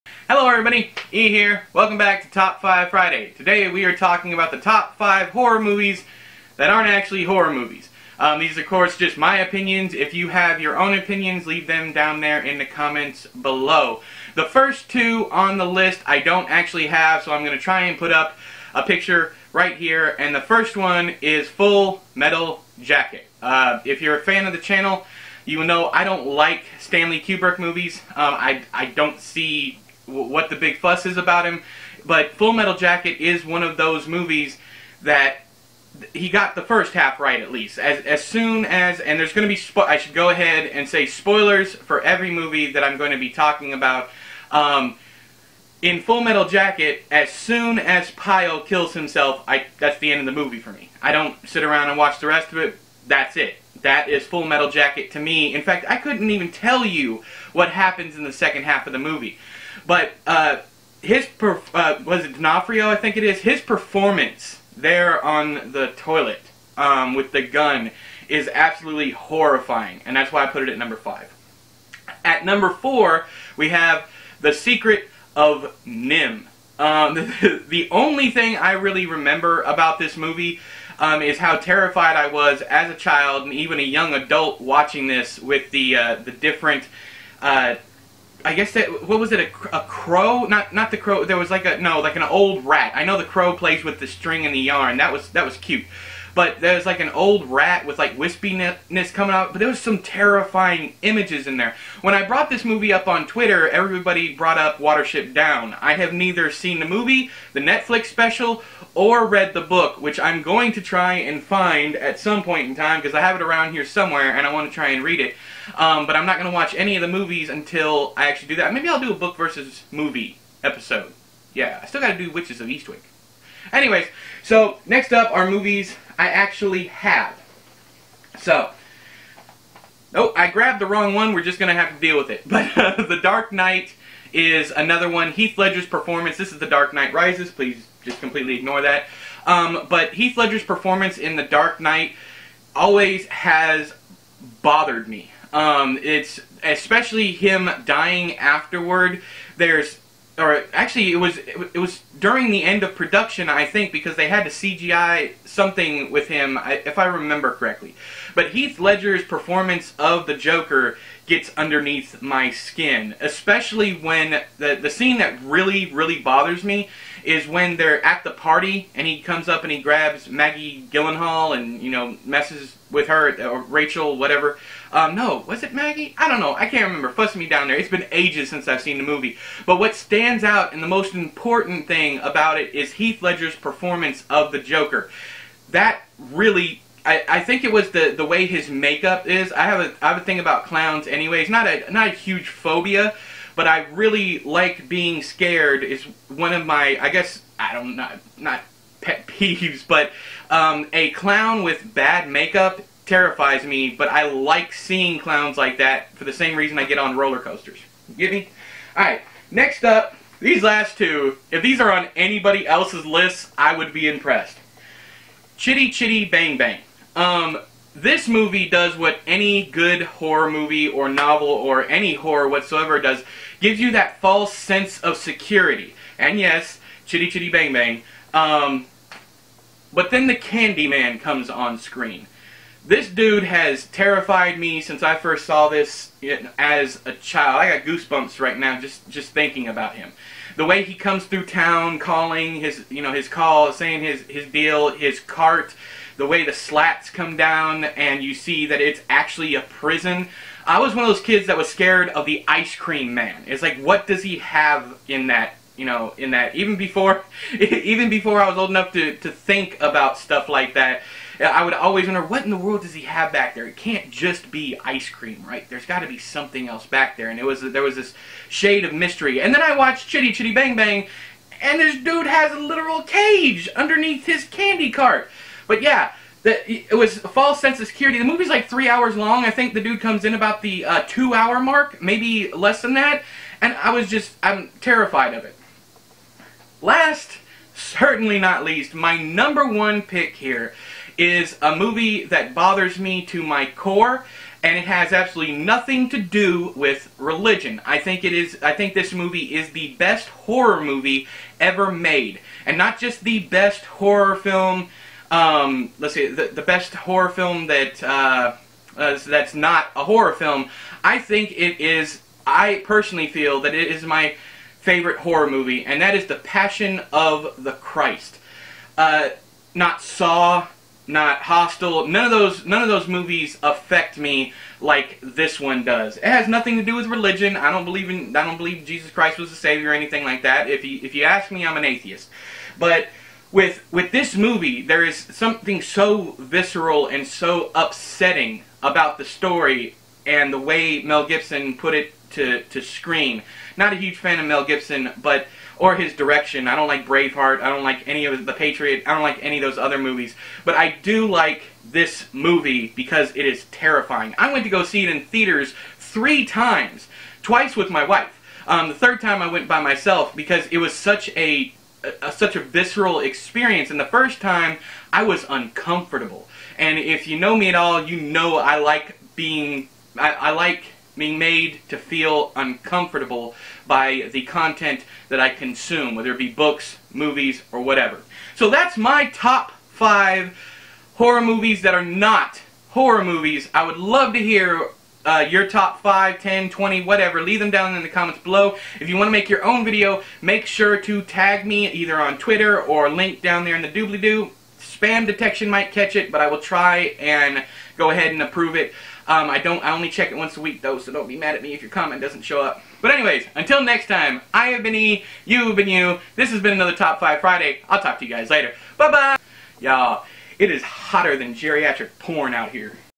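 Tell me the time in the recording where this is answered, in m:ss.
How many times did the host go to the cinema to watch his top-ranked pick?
5:55.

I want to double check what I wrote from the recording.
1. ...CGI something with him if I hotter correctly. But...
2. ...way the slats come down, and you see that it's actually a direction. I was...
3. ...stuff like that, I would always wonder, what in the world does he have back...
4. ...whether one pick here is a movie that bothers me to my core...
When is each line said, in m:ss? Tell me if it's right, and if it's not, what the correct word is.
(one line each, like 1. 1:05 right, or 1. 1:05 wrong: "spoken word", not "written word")
1. 2:34 wrong: "remember", not "hotter"
2. 4:06 wrong: "prison", not "direction"
3. 4:20 right
4. 4:49 wrong: "number", not "whether".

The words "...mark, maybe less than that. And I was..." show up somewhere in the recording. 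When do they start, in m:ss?
4:41.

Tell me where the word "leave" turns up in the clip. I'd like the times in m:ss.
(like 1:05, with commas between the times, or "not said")
0:11, 6:27.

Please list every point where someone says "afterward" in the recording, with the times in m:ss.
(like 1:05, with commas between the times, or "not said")
2:28.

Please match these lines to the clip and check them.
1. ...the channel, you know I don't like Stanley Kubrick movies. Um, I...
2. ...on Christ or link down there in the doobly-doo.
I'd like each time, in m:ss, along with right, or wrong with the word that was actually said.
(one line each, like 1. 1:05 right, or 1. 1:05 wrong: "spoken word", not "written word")
1. 0:24 right
2. 6:32 wrong: "Twitter", not "Christ".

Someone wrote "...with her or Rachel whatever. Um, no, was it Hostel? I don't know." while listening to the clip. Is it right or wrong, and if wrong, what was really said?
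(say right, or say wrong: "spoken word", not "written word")
wrong: "Maggie", not "Hostel".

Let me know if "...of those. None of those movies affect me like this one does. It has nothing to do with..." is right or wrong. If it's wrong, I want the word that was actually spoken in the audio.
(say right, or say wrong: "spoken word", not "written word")
right.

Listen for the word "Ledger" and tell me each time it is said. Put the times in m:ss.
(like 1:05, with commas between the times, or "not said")
2:15, 2:20, 2:38, 3:03.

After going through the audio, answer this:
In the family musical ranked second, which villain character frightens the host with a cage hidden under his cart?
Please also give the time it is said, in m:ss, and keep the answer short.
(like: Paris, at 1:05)
The Candyman, at 3:50.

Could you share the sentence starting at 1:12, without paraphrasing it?
At number four, we have the secret of NIMH.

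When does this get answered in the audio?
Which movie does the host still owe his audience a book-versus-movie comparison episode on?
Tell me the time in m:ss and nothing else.
2:02.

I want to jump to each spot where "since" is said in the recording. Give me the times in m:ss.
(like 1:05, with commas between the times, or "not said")
2:58, 3:54.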